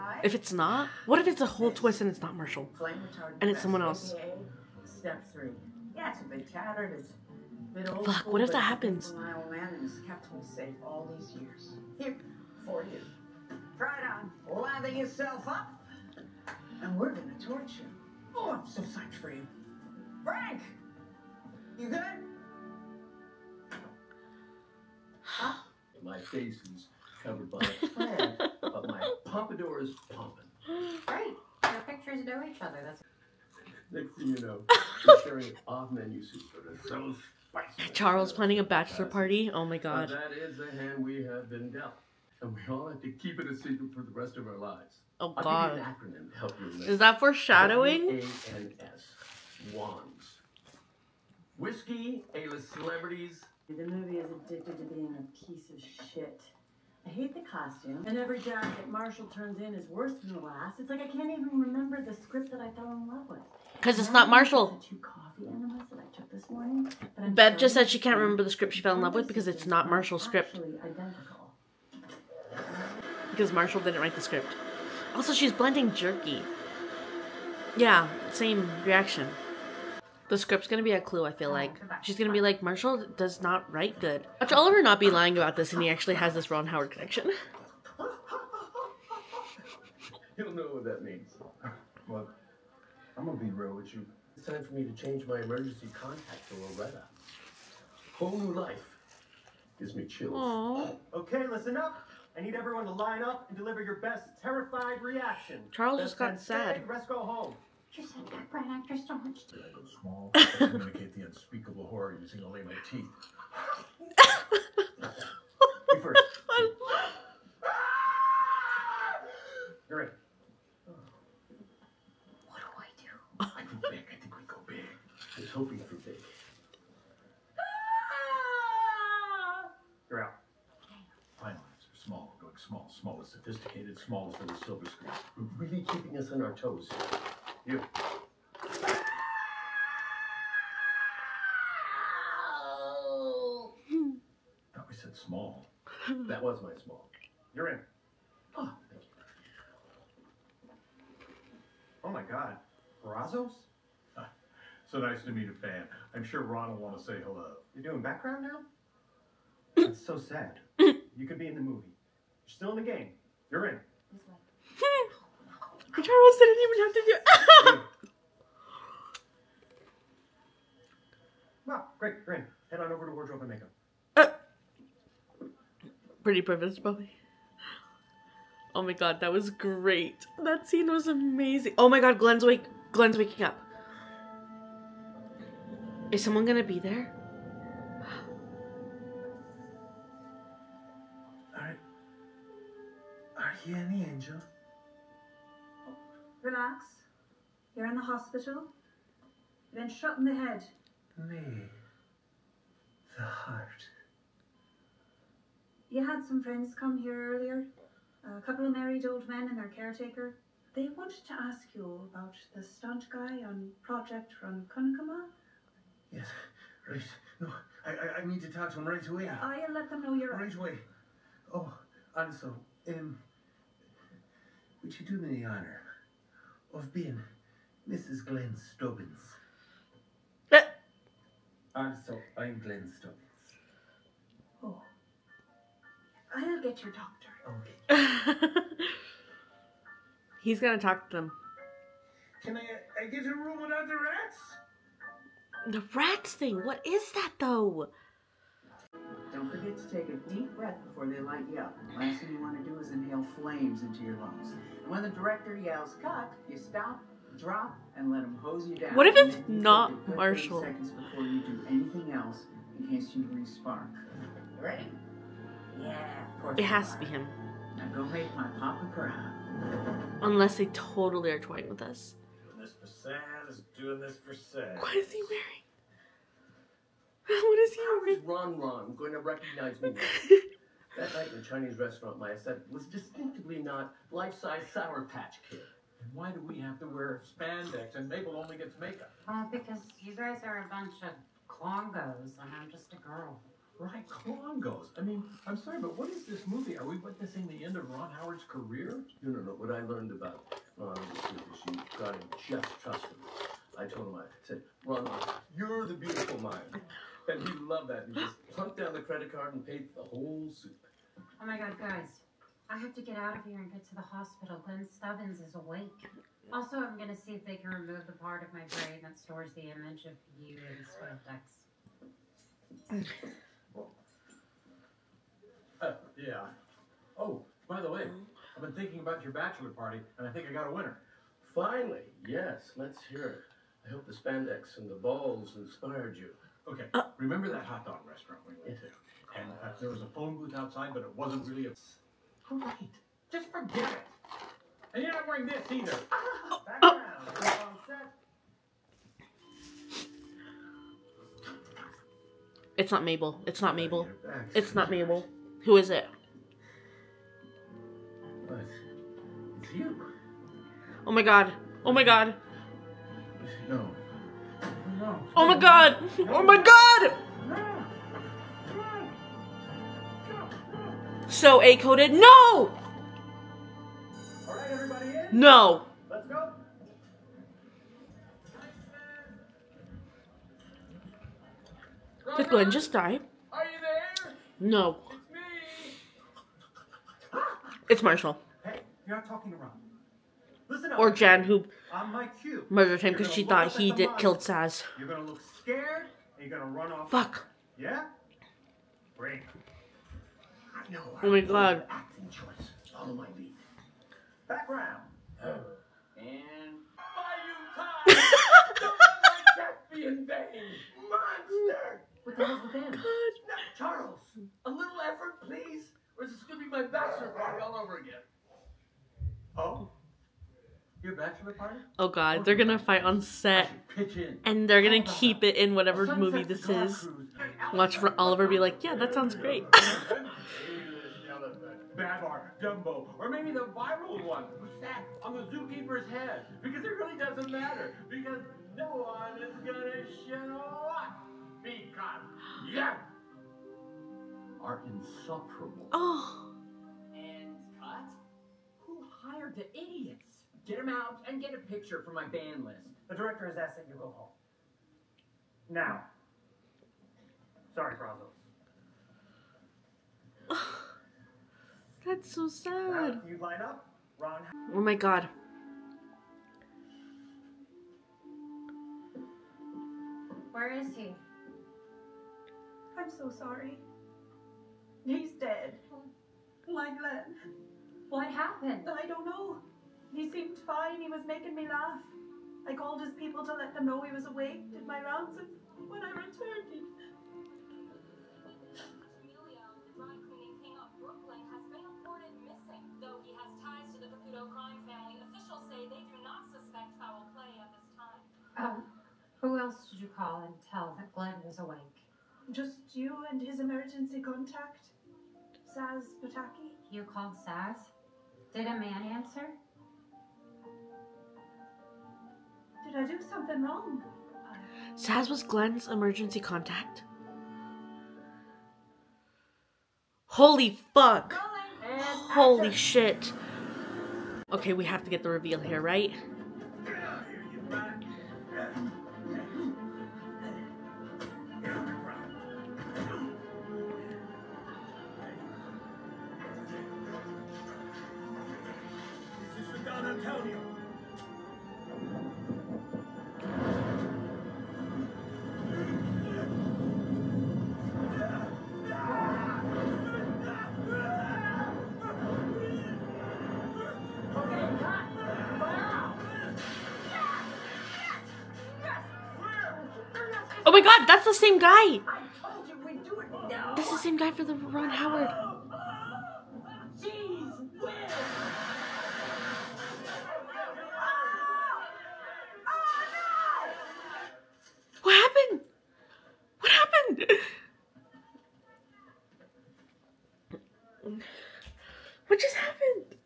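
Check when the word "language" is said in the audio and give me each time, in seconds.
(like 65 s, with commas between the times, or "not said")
not said.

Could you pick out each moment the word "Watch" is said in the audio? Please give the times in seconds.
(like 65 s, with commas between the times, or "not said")
84 s, 427 s.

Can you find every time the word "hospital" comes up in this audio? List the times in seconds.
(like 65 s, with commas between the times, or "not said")
198 s, 314 s.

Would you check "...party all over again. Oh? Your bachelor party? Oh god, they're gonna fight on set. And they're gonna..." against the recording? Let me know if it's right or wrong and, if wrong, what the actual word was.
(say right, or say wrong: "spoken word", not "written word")
right.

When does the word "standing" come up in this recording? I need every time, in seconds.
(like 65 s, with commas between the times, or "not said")
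not said.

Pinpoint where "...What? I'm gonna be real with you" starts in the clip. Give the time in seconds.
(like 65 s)
92 s.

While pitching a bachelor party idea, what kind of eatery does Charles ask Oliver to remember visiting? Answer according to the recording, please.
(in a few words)
Hot dog restaurant.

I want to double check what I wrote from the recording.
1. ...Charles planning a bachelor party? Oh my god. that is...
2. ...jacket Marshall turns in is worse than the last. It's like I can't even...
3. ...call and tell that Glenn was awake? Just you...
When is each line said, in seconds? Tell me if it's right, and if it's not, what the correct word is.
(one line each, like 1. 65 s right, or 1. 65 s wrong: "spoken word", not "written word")
1. 37 s right
2. 58 s right
3. 500 s right.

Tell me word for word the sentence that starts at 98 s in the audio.
Whole new life gives me chills.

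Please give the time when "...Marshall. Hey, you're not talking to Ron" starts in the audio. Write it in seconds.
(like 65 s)
388 s.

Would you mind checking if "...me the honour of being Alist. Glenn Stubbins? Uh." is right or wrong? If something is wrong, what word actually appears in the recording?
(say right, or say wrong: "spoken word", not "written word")
wrong: "Mrs", not "Alist".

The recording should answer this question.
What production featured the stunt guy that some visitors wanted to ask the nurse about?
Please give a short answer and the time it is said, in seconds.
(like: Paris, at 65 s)
Project Ronkonkoma, at 213 s.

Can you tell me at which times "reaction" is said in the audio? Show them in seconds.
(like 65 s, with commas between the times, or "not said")
78 s, 105 s.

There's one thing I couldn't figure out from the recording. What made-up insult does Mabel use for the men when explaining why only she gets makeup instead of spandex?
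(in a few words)
Clongos.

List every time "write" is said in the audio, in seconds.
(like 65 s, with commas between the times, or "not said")
74 s, 83 s.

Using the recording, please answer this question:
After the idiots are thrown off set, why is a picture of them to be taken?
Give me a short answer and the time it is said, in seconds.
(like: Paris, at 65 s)
Ban list, at 452 s.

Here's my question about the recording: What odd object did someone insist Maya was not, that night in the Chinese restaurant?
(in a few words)
Life-size Sour Patch Kid.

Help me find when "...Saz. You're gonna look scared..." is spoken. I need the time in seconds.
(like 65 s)
394 s.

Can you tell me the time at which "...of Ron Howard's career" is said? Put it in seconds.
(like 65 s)
297 s.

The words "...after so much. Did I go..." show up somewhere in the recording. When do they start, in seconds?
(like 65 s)
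108 s.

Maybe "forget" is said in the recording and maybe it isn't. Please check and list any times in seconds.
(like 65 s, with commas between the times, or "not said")
249 s, 343 s.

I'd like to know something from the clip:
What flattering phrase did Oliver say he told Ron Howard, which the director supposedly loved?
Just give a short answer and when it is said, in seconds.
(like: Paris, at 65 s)
The beautiful mind, at 305 s.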